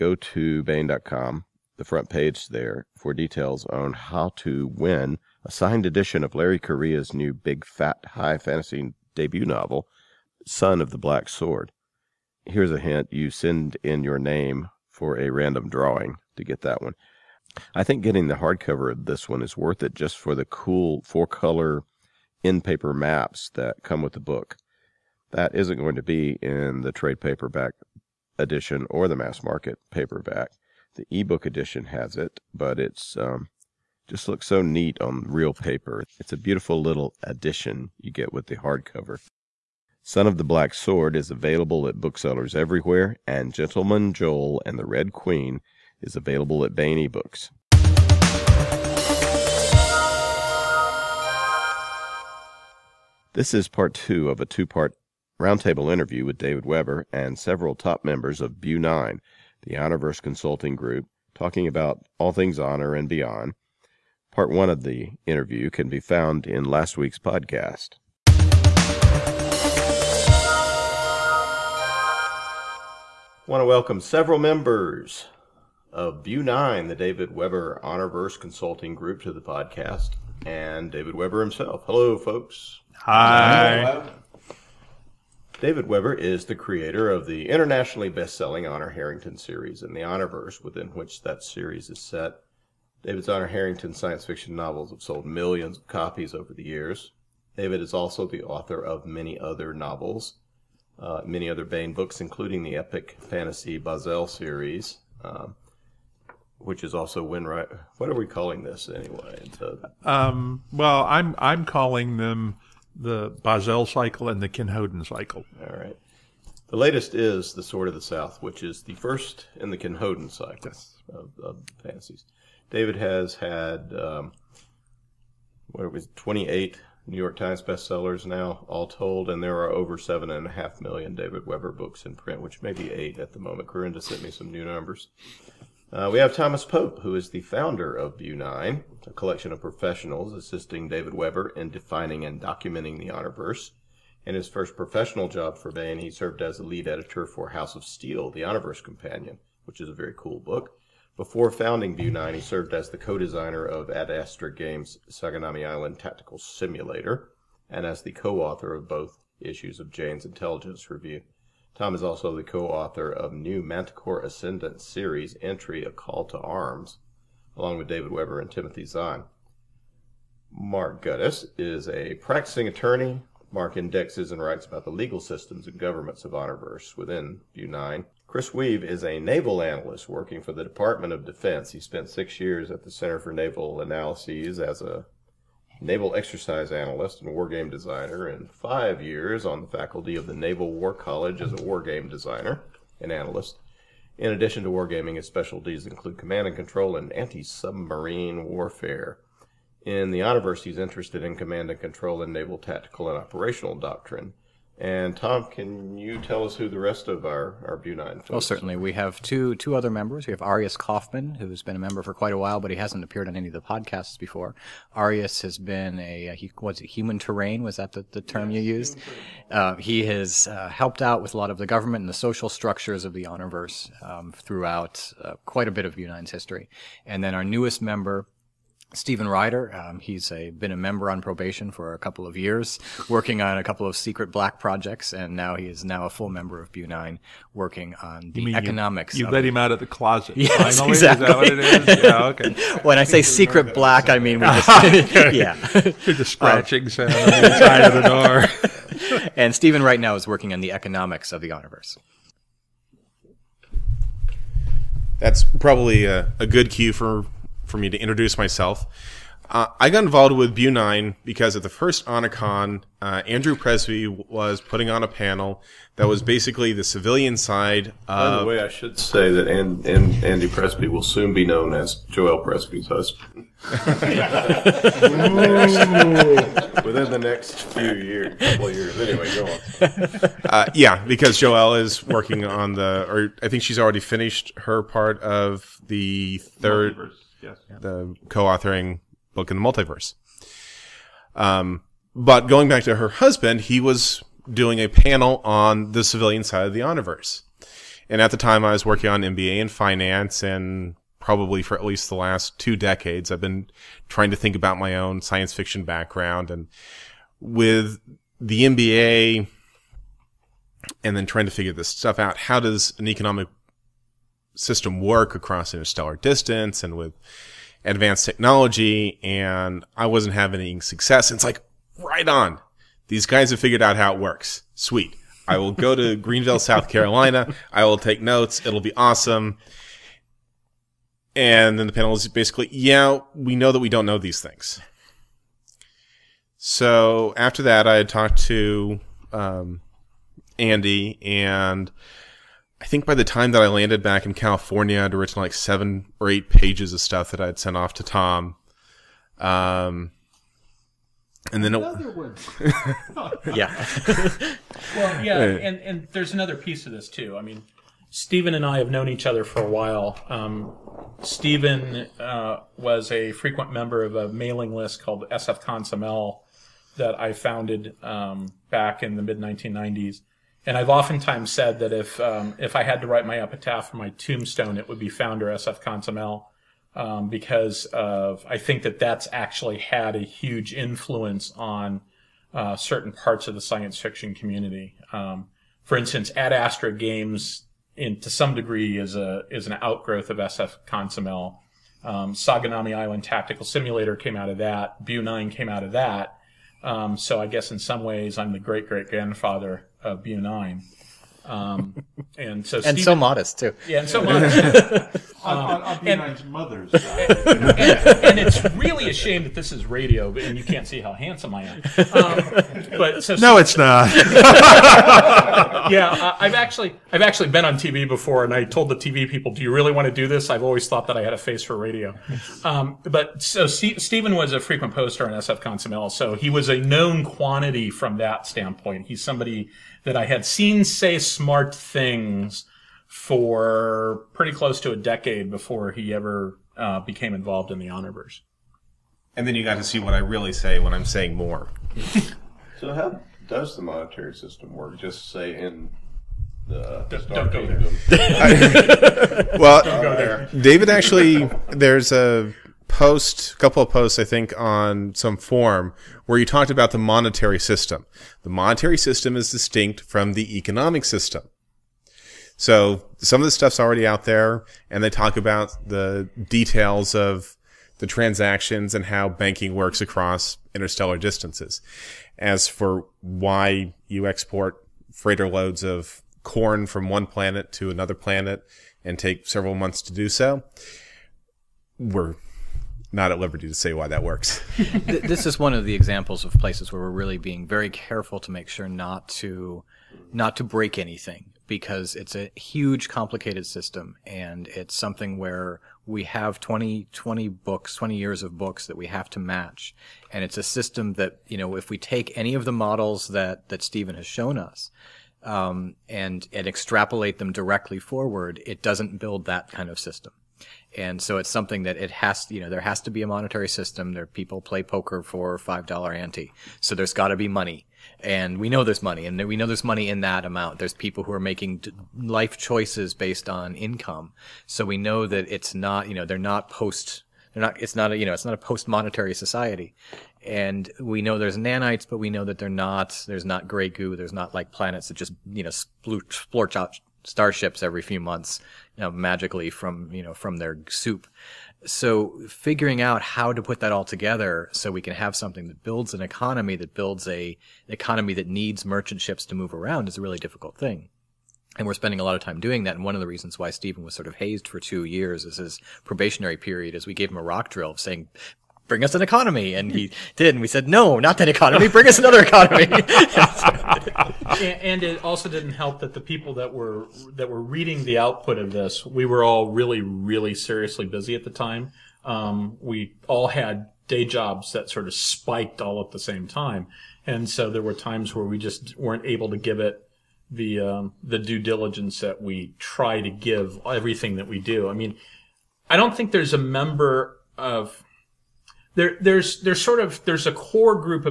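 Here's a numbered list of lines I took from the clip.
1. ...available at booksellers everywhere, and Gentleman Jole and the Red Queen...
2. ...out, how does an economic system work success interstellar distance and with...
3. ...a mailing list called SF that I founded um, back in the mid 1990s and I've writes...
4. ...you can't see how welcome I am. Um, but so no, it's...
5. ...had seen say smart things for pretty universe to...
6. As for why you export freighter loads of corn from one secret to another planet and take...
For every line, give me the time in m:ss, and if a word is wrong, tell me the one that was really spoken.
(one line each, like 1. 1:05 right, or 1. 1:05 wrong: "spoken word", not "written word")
1. 0:41 right
2. 5:12 wrong: "across", not "success"
3. 6:04 wrong: "oftentimes", not "writes"
4. 6:50 wrong: "handsome", not "welcome"
5. 7:10 wrong: "close", not "universe"
6. 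7:52 wrong: "planet", not "secret".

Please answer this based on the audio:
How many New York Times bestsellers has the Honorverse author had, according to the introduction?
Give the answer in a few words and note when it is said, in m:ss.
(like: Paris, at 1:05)
28, at 2:06.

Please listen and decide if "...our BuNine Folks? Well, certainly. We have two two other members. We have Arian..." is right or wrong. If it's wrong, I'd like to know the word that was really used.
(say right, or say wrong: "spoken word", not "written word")
right.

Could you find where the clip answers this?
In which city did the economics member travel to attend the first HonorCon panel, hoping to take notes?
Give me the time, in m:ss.
5:26.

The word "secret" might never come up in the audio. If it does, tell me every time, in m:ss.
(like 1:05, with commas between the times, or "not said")
3:53, 4:03.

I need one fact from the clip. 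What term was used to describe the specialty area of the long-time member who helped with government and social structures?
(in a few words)
human terrain.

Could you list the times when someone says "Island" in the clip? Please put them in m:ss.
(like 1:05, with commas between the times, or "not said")
2:35, 6:32.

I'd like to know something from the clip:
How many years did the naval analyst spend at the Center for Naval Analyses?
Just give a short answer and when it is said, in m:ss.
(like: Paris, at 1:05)
6, at 3:02.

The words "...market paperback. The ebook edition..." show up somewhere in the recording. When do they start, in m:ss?
0:29.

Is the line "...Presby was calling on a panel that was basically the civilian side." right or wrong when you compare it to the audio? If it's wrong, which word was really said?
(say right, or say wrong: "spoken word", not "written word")
wrong: "putting", not "calling".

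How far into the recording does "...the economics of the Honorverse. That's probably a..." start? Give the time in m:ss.
4:10.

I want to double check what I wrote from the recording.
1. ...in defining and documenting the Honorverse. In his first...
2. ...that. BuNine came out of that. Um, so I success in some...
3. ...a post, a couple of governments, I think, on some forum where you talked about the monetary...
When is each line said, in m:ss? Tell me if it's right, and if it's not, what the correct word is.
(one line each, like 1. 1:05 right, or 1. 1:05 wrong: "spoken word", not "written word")
1. 2:21 right
2. 6:34 wrong: "guess", not "success"
3. 7:32 wrong: "posts", not "governments".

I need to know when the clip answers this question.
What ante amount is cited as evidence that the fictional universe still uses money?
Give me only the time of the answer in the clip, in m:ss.
8:35.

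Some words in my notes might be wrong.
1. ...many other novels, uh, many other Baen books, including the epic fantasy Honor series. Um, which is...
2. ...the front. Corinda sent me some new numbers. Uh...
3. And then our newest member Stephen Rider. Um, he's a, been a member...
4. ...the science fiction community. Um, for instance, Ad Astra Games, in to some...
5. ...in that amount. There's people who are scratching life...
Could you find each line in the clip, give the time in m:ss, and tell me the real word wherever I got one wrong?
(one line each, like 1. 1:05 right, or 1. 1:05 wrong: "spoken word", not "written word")
1. 1:39 wrong: "Bahzell", not "Honor"
2. 2:13 wrong: "moment", not "front"
3. 3:47 right
4. 6:23 right
5. 8:40 wrong: "making", not "scratching".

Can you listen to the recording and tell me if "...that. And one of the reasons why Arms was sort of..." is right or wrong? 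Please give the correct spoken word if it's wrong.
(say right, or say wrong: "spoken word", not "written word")
wrong: "Stephen", not "Arms".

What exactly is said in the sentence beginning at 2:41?
Tom is also the co-author of New Manticore Ascendant series entry, A Call to Arms, along with David Weber and Timothy Zahn.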